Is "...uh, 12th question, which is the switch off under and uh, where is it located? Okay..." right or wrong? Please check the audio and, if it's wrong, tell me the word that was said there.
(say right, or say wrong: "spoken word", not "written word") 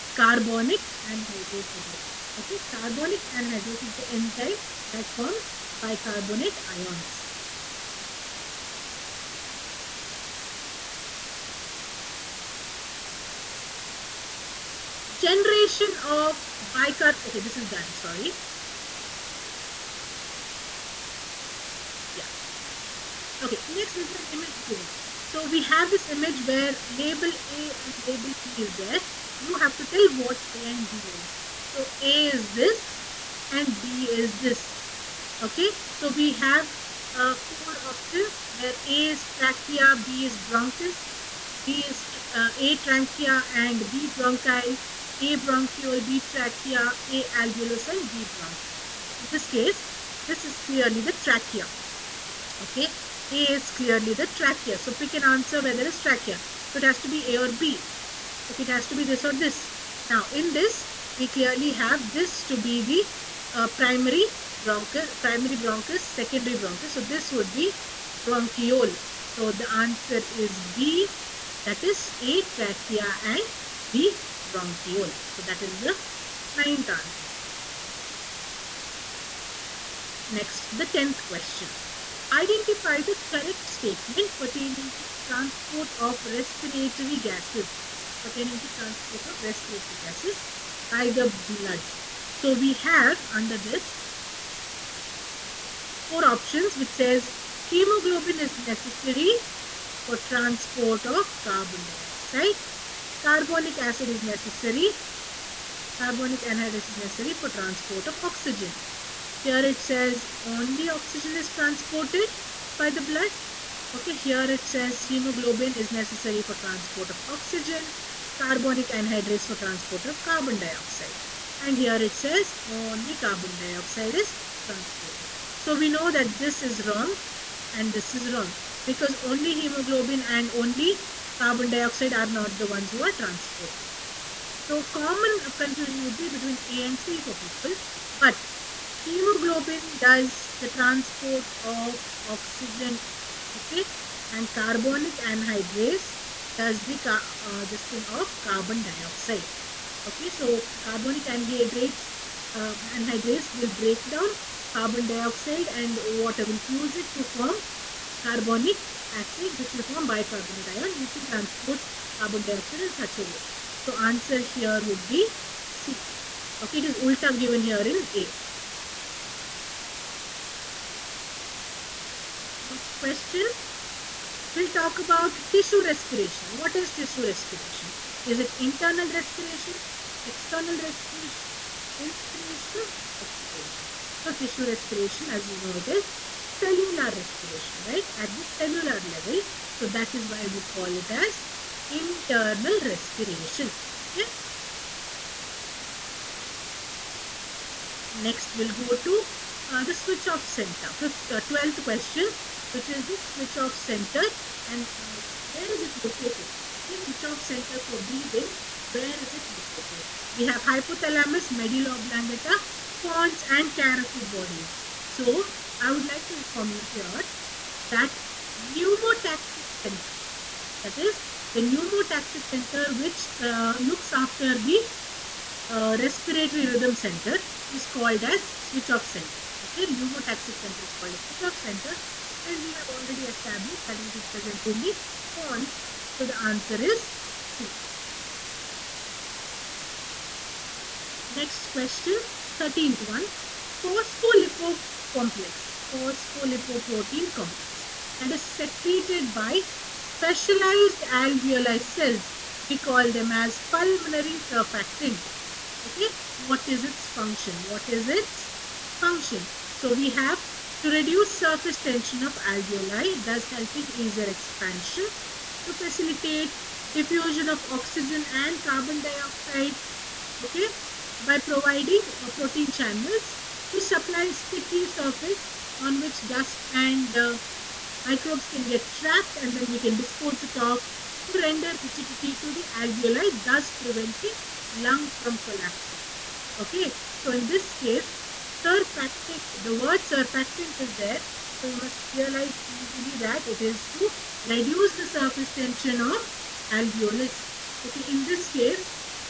wrong: "center", not "under".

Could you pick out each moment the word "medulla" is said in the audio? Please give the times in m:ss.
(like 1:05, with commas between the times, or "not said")
3:31.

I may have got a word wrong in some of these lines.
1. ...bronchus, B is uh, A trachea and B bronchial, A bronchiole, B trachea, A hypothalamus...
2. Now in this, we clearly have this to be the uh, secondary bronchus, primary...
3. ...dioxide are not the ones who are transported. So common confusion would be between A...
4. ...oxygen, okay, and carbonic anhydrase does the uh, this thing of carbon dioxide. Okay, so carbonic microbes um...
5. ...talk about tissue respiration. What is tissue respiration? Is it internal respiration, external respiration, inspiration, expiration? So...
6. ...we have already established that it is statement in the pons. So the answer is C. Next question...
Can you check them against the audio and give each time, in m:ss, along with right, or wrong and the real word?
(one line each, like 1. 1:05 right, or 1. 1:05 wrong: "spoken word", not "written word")
1. 0:40 wrong: "alveolus", not "hypothalamus"
2. 1:00 wrong: "primary", not "secondary"
3. 2:11 right
4. 2:22 wrong: "anhydrates", not "microbes"
5. 2:54 right
6. 3:52 wrong: "present", not "statement".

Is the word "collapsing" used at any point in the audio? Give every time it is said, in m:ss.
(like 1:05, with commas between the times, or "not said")
4:45.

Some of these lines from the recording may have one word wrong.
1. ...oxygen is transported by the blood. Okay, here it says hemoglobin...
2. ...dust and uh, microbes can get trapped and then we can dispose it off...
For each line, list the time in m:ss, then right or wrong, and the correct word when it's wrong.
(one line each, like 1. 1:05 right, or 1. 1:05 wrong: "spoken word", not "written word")
1. 1:50 right
2. 4:36 right.